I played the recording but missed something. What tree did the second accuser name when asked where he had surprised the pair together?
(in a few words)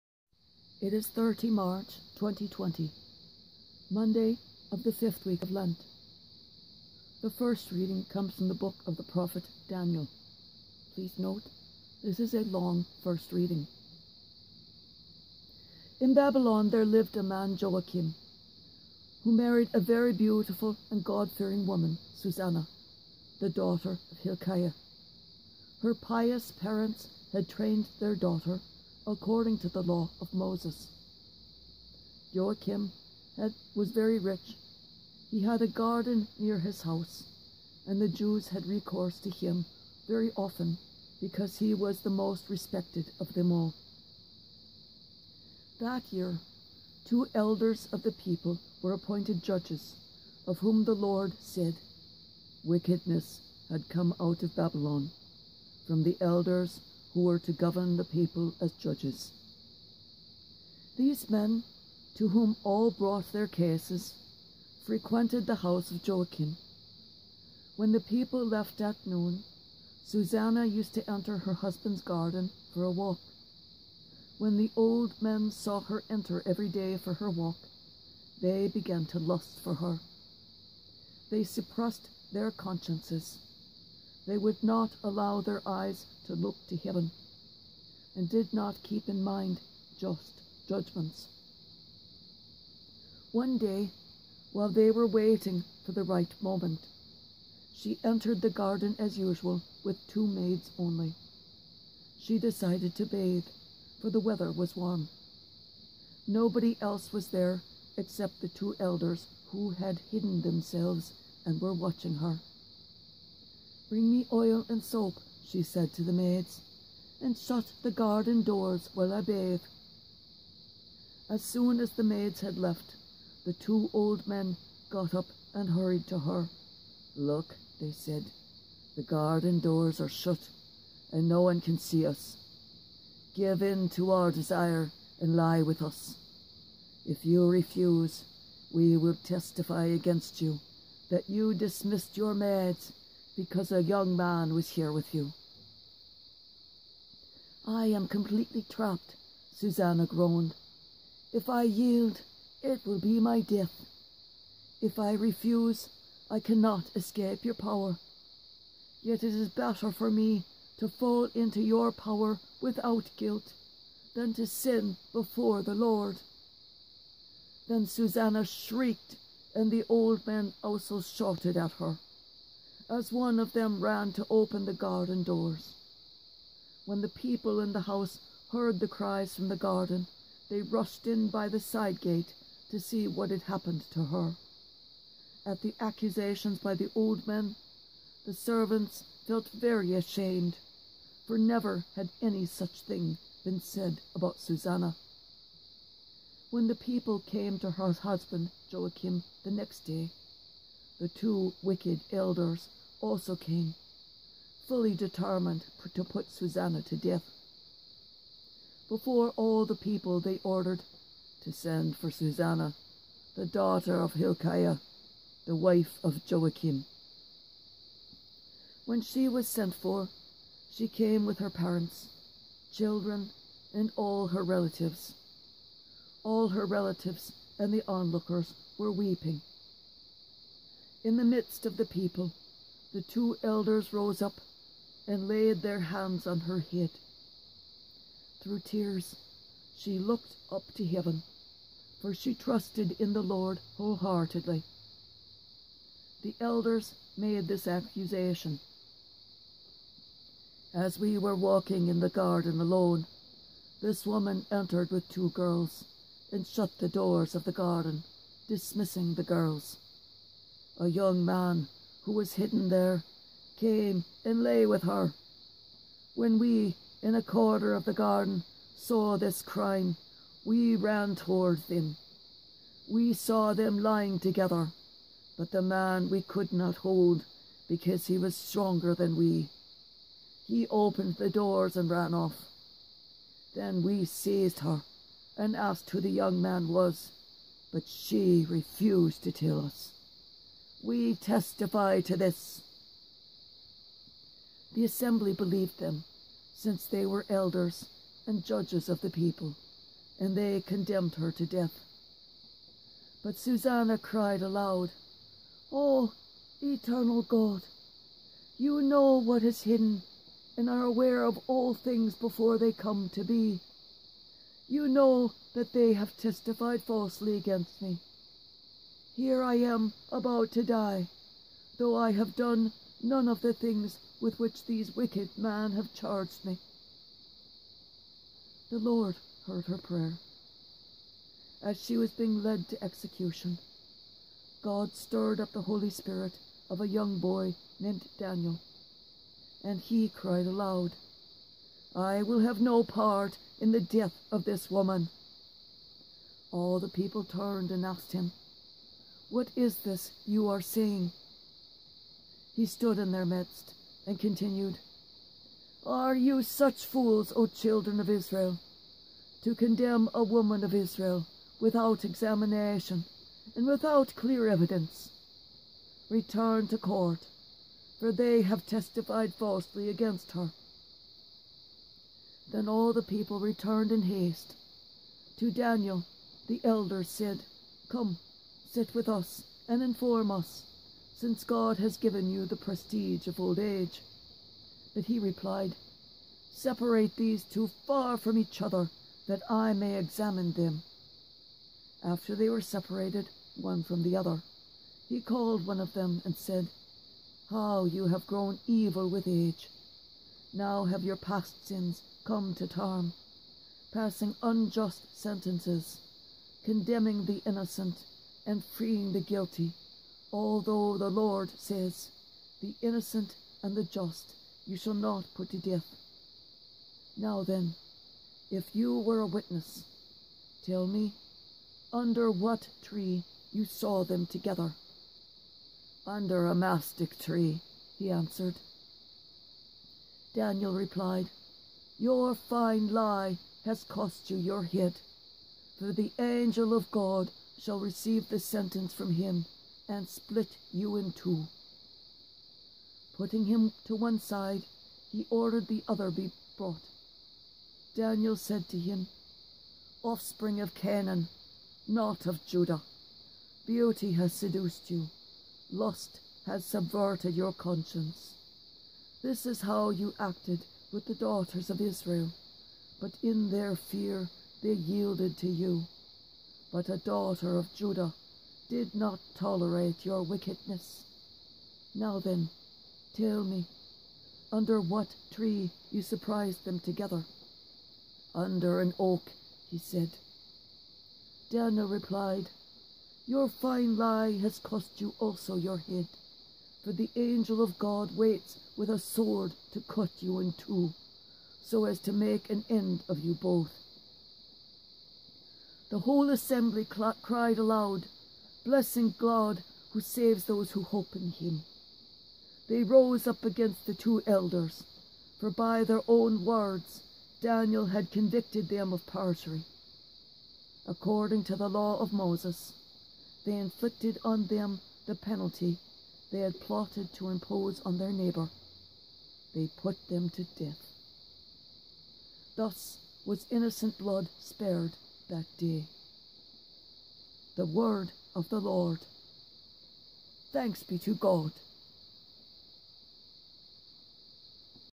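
An oak.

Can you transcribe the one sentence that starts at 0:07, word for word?
The first reading comes from the book of the prophet Daniel.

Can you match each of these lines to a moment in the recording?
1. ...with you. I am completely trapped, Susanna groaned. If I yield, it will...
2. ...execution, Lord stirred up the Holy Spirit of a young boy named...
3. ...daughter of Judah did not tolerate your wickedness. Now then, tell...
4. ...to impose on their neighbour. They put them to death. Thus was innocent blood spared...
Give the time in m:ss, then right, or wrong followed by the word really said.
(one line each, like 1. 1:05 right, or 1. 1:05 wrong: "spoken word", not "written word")
1. 2:24 right
2. 5:32 wrong: "God", not "Lord"
3. 7:46 right
4. 8:37 right.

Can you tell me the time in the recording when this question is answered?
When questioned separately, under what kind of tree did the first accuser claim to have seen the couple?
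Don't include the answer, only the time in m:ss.
7:06.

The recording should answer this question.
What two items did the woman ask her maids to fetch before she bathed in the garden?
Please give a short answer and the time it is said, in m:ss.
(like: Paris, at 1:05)
Oil and soap, at 1:54.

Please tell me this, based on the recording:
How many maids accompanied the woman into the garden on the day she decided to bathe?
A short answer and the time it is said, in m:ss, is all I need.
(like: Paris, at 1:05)
2, at 1:40.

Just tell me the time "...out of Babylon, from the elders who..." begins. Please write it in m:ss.
0:54.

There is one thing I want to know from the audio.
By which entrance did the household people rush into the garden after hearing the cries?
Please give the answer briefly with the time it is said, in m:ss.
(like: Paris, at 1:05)
The side gate, at 3:01.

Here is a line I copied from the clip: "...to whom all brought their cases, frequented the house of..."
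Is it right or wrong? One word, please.
right.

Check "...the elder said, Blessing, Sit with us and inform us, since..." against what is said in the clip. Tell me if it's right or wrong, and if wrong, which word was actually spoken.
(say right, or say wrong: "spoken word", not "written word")
wrong: "Come", not "Blessing".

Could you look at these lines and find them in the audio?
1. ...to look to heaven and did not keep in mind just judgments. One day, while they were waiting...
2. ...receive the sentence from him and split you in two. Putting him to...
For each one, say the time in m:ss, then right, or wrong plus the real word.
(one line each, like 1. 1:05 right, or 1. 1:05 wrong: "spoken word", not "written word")
1. 1:26 right
2. 7:17 right.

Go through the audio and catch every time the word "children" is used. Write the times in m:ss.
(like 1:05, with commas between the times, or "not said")
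3:42, 5:57.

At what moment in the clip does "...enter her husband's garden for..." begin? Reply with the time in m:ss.
1:11.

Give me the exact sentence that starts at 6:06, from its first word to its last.
Return to court, for they have testified falsely against her.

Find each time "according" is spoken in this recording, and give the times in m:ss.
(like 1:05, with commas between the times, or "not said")
0:29, 8:30.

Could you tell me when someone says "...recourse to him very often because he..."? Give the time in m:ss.
0:38.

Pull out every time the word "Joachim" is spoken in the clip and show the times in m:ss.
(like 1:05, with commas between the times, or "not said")
0:17, 0:32, 1:06, 3:18, 3:36.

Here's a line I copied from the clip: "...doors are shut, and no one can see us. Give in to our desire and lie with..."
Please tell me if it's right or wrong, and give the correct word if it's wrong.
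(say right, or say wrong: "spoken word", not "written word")
right.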